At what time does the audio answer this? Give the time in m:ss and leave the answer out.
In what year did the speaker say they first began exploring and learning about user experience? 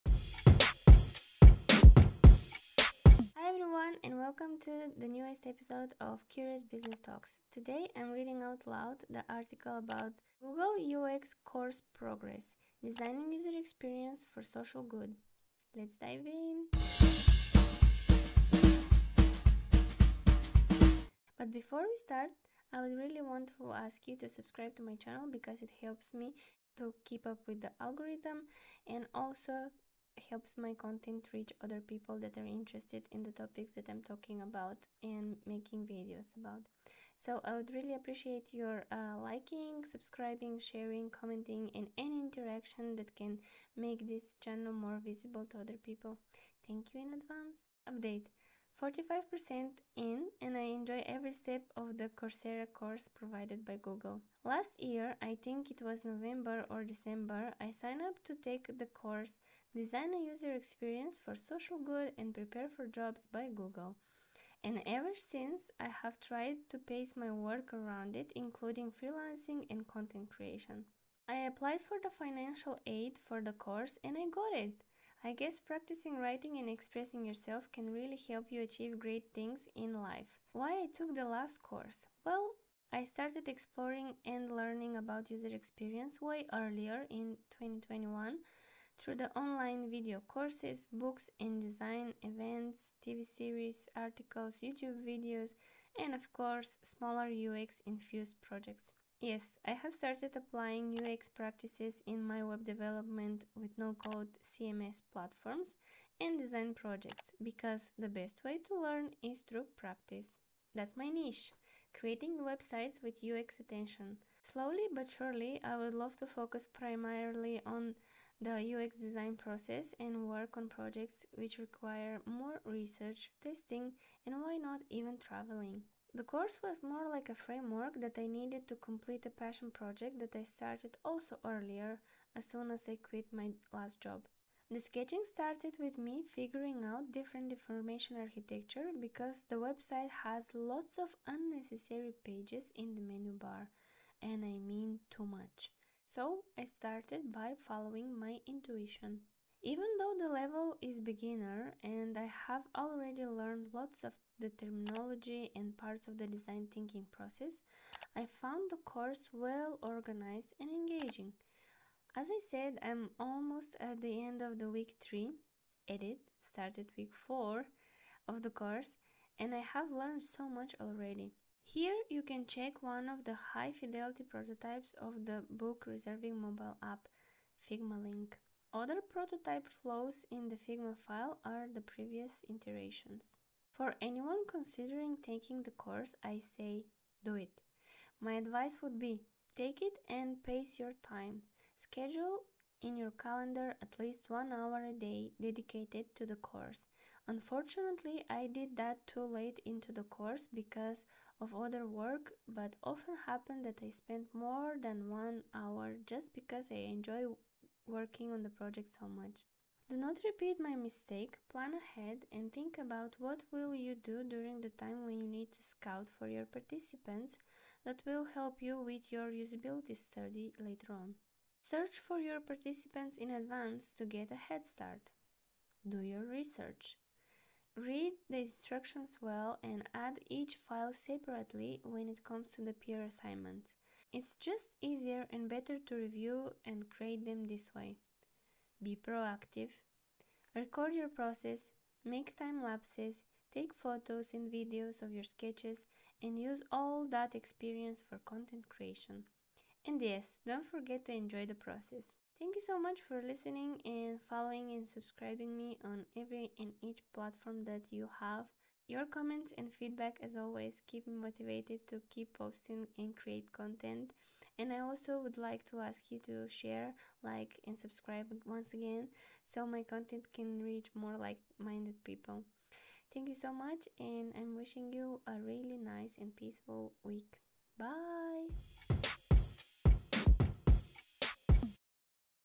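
1:27.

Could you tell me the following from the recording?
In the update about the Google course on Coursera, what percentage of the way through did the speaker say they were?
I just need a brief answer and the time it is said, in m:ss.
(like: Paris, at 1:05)
45%, at 0:48.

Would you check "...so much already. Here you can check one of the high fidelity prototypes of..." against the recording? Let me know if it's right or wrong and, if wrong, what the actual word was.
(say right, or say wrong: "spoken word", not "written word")
right.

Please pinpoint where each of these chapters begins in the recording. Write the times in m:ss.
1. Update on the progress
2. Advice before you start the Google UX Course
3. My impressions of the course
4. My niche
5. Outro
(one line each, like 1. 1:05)
1. 0:45
2. 3:07
3. 2:37
4. 1:49
5. 4:18.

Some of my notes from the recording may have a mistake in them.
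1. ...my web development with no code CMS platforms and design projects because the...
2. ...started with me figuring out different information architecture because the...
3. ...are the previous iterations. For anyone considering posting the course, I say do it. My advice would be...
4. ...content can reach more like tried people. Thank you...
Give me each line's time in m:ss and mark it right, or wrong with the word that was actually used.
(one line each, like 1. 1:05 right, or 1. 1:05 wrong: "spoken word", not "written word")
1. 1:42 right
2. 2:15 right
3. 3:01 wrong: "taking", not "posting"
4. 4:29 wrong: "minded", not "tried".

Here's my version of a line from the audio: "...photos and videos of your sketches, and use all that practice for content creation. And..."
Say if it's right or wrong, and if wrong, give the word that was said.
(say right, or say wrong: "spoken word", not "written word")
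wrong: "experience", not "practice".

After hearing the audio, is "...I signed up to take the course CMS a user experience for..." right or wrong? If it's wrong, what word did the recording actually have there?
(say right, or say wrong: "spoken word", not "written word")
wrong: "Design", not "CMS".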